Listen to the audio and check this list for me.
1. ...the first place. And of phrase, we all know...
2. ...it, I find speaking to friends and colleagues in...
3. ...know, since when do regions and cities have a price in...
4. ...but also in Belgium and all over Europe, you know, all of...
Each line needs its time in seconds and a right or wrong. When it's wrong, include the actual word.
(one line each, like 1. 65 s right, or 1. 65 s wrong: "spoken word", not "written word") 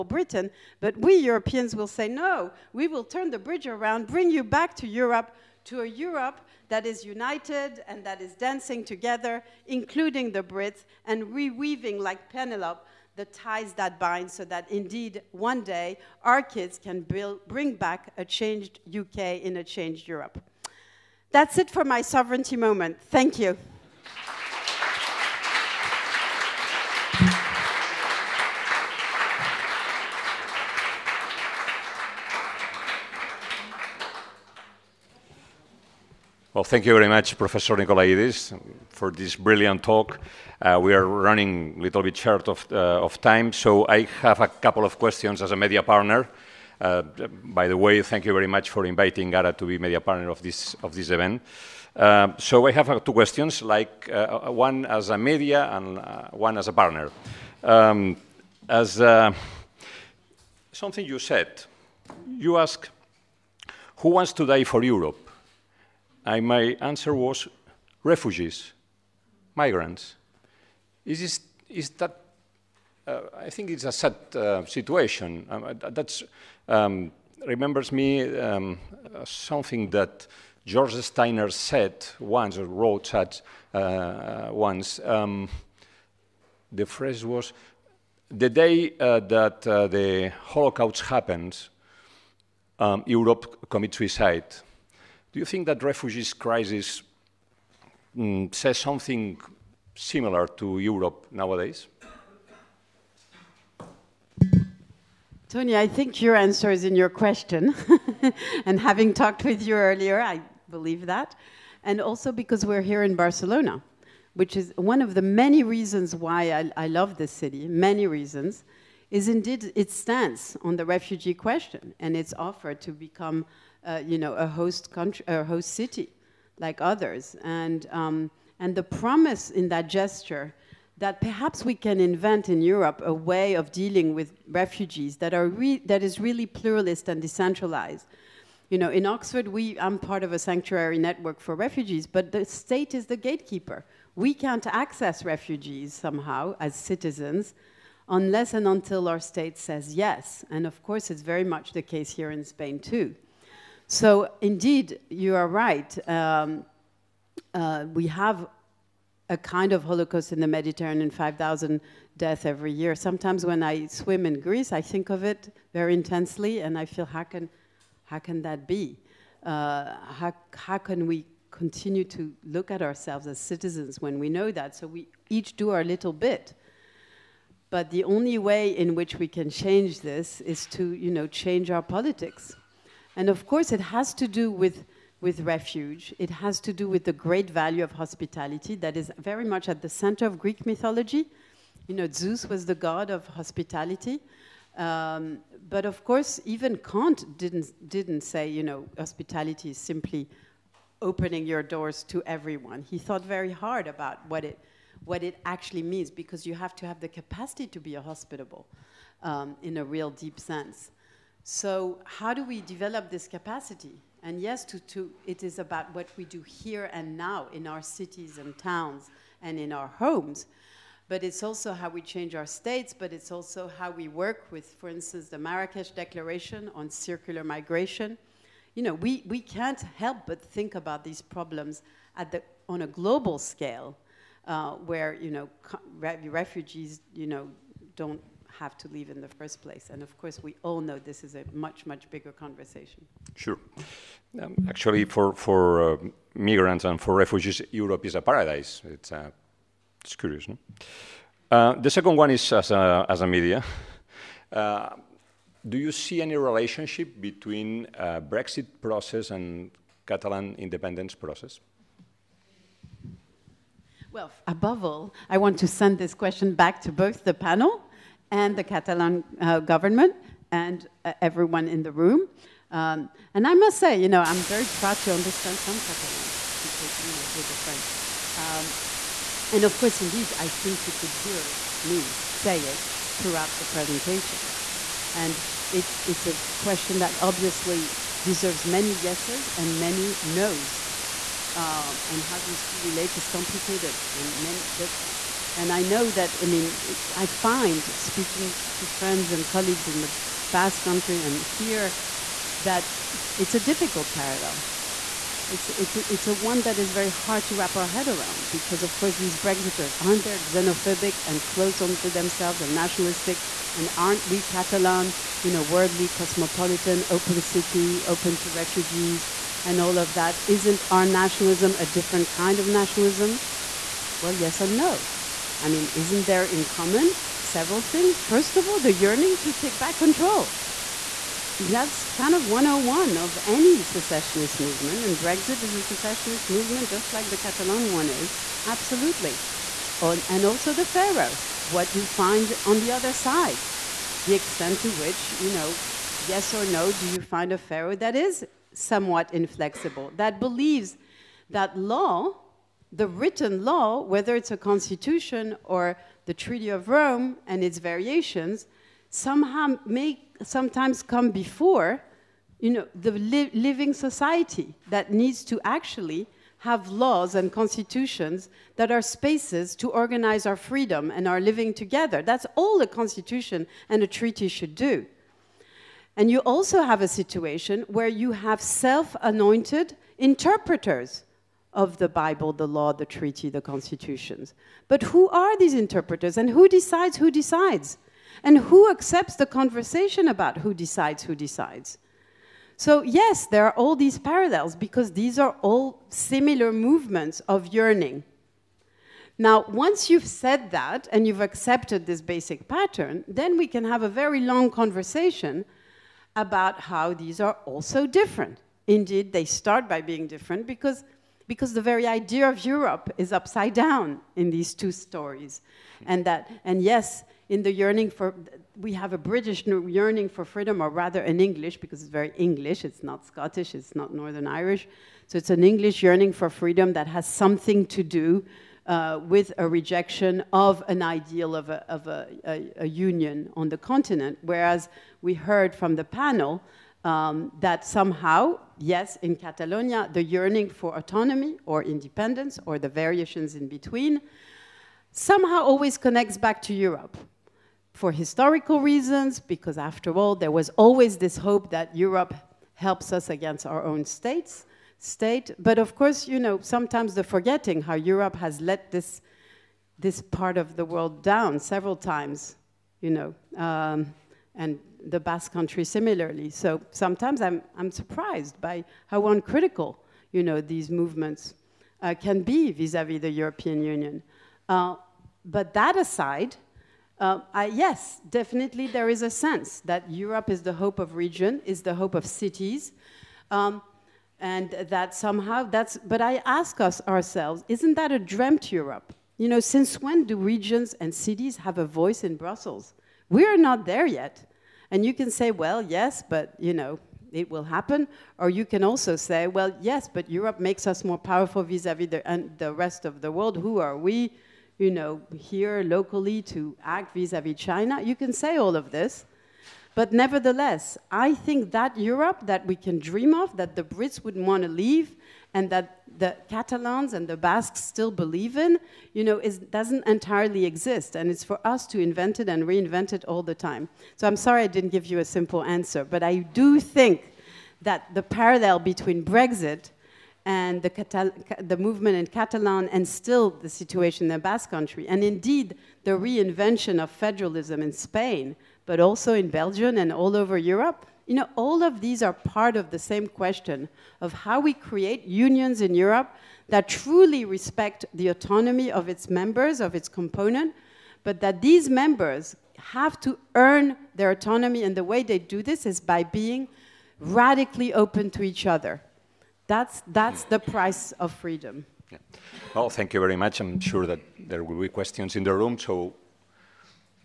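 1. 239 s wrong: "course", not "phrase"
2. 296 s right
3. 489 s wrong: "voice", not "price"
4. 538 s right.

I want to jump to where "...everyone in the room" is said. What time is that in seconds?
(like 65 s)
271 s.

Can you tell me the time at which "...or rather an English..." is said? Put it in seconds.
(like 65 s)
420 s.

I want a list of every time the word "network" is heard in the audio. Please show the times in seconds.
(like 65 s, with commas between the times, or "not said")
140 s.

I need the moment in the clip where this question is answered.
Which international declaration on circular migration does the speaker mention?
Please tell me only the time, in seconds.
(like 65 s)
225 s.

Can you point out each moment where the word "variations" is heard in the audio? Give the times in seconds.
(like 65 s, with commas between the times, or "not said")
357 s, 442 s.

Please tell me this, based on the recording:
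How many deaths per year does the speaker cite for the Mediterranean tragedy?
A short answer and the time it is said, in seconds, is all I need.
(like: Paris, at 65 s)
5,000, at 161 s.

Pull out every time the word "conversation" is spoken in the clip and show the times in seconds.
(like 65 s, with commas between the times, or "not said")
242 s, 389 s, 404 s.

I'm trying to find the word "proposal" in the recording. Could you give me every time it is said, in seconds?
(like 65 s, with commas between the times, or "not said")
not said.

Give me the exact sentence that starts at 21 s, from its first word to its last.
That's it for my sovereignty moment.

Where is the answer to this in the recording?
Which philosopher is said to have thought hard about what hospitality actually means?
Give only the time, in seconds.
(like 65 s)
196 s.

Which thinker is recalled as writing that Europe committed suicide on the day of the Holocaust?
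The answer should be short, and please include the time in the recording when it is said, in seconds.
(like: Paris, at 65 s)
George Steiner, at 80 s.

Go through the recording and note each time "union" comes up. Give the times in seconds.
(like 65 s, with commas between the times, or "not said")
432 s, 473 s, 545 s.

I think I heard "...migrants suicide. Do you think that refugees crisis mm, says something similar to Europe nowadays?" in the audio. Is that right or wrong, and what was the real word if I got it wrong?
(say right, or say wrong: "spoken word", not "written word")
wrong: "commits", not "migrants".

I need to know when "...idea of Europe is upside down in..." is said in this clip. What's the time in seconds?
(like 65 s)
412 s.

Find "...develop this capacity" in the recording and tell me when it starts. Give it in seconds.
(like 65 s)
212 s.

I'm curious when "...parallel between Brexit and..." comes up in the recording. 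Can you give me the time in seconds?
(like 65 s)
528 s.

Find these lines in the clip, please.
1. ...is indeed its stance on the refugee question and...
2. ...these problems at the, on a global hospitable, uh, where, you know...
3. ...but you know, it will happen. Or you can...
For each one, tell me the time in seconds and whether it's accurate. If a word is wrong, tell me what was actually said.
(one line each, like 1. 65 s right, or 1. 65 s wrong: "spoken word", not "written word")
1. 119 s right
2. 231 s wrong: "scale", not "hospitable"
3. 496 s right.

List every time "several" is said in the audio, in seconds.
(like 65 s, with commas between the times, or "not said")
327 s, 461 s.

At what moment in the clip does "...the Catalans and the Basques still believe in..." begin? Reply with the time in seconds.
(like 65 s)
516 s.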